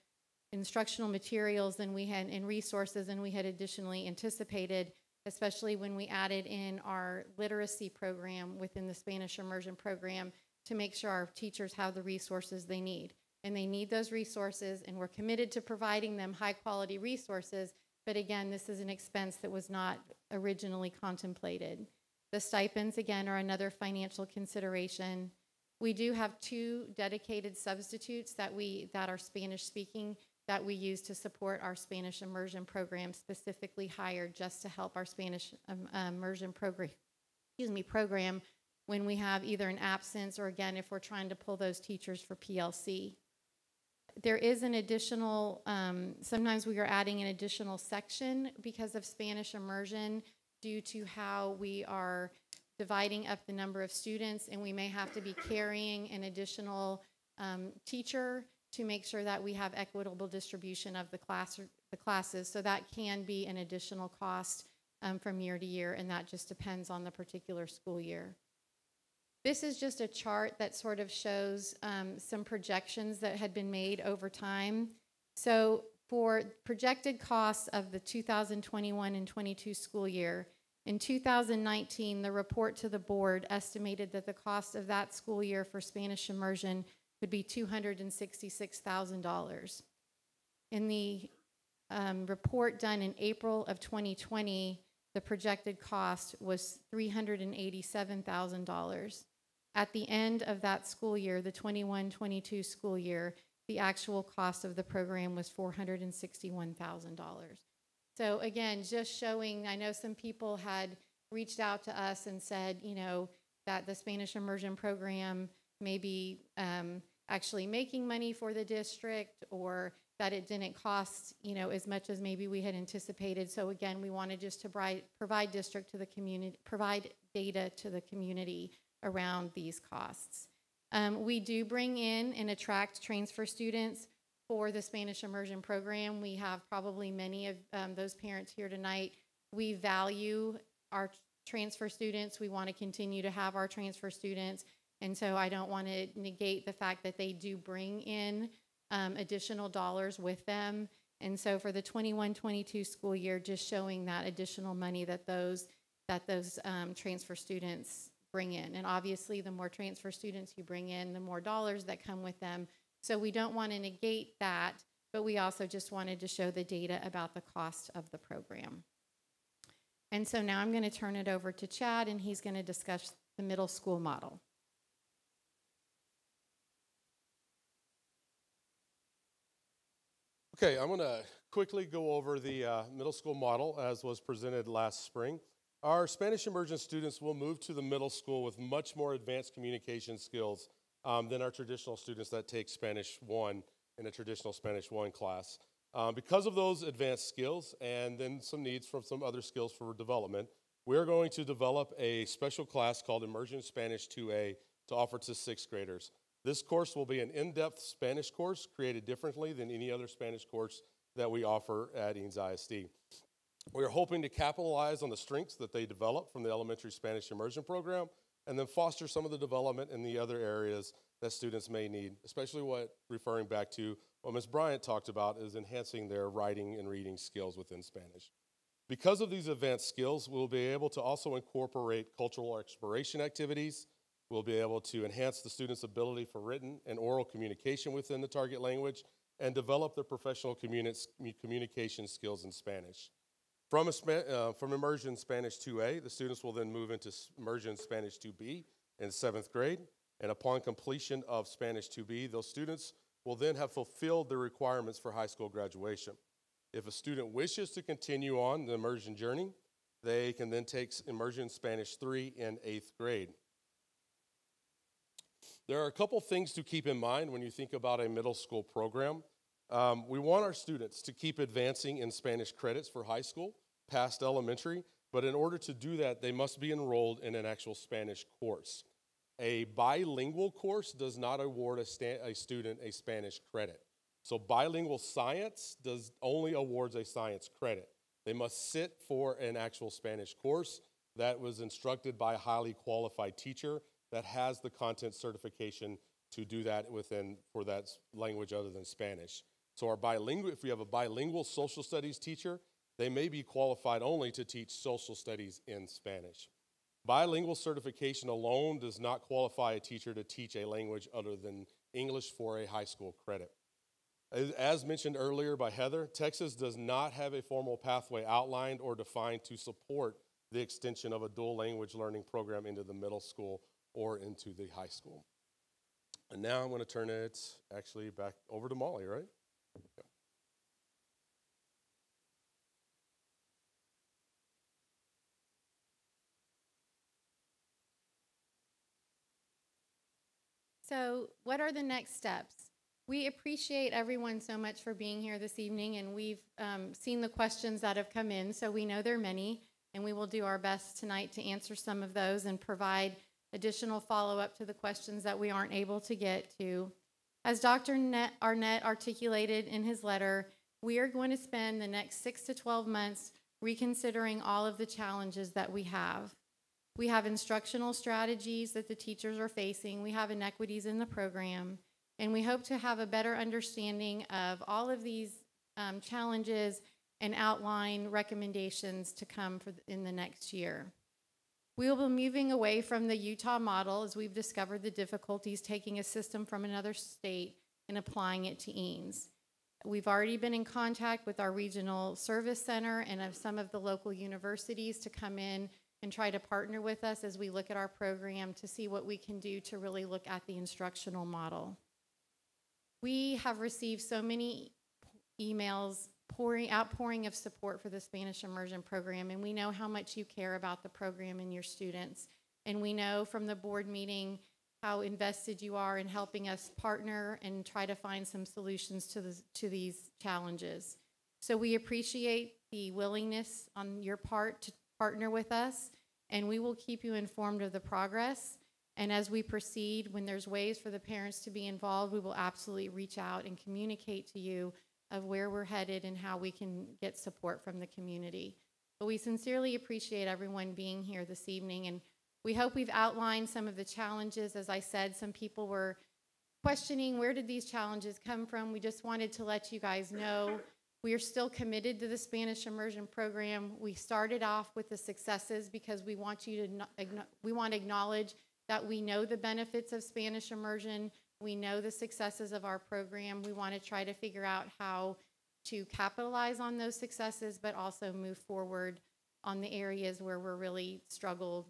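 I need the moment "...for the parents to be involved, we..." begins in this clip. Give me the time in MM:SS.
07:10.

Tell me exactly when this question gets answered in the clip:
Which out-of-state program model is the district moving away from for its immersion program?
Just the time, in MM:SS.
06:23.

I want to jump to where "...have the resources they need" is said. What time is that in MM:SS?
00:11.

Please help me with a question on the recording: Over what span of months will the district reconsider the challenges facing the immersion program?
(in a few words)
6 to 12 months.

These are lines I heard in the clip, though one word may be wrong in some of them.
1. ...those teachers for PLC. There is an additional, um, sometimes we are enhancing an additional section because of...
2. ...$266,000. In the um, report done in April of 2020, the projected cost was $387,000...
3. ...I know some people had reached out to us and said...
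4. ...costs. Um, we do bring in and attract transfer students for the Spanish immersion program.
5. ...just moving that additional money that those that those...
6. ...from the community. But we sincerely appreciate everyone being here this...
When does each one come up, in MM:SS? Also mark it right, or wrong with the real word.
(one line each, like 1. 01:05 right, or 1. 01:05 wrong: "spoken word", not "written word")
1. 00:41 wrong: "adding", not "enhancing"
2. 01:27 right
3. 01:49 right
4. 02:09 right
5. 02:33 wrong: "showing", not "moving"
6. 07:17 right.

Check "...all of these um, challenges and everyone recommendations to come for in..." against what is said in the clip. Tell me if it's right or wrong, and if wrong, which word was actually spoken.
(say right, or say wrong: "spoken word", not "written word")
wrong: "outline", not "everyone".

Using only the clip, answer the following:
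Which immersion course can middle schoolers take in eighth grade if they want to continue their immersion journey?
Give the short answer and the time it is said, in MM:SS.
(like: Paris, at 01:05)
Immersion Spanish 3, at 04:21.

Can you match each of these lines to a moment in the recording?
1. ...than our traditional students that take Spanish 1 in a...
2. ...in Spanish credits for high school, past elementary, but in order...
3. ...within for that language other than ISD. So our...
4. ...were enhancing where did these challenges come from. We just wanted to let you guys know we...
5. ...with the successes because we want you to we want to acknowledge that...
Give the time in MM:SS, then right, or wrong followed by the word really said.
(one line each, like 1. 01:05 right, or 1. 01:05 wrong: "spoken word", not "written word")
1. 03:11 right
2. 04:31 right
3. 04:56 wrong: "Spanish", not "ISD"
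4. 07:25 wrong: "questioning", not "enhancing"
5. 07:34 right.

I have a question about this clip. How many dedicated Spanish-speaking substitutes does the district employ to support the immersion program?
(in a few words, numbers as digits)
2.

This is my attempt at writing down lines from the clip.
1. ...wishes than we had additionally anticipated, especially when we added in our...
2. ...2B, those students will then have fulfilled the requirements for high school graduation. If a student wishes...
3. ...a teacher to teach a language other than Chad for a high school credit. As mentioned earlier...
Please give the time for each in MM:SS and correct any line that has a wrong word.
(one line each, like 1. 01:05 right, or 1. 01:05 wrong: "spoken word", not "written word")
1. 00:02 wrong: "resources", not "wishes"
2. 04:11 right
3. 05:09 wrong: "English", not "Chad".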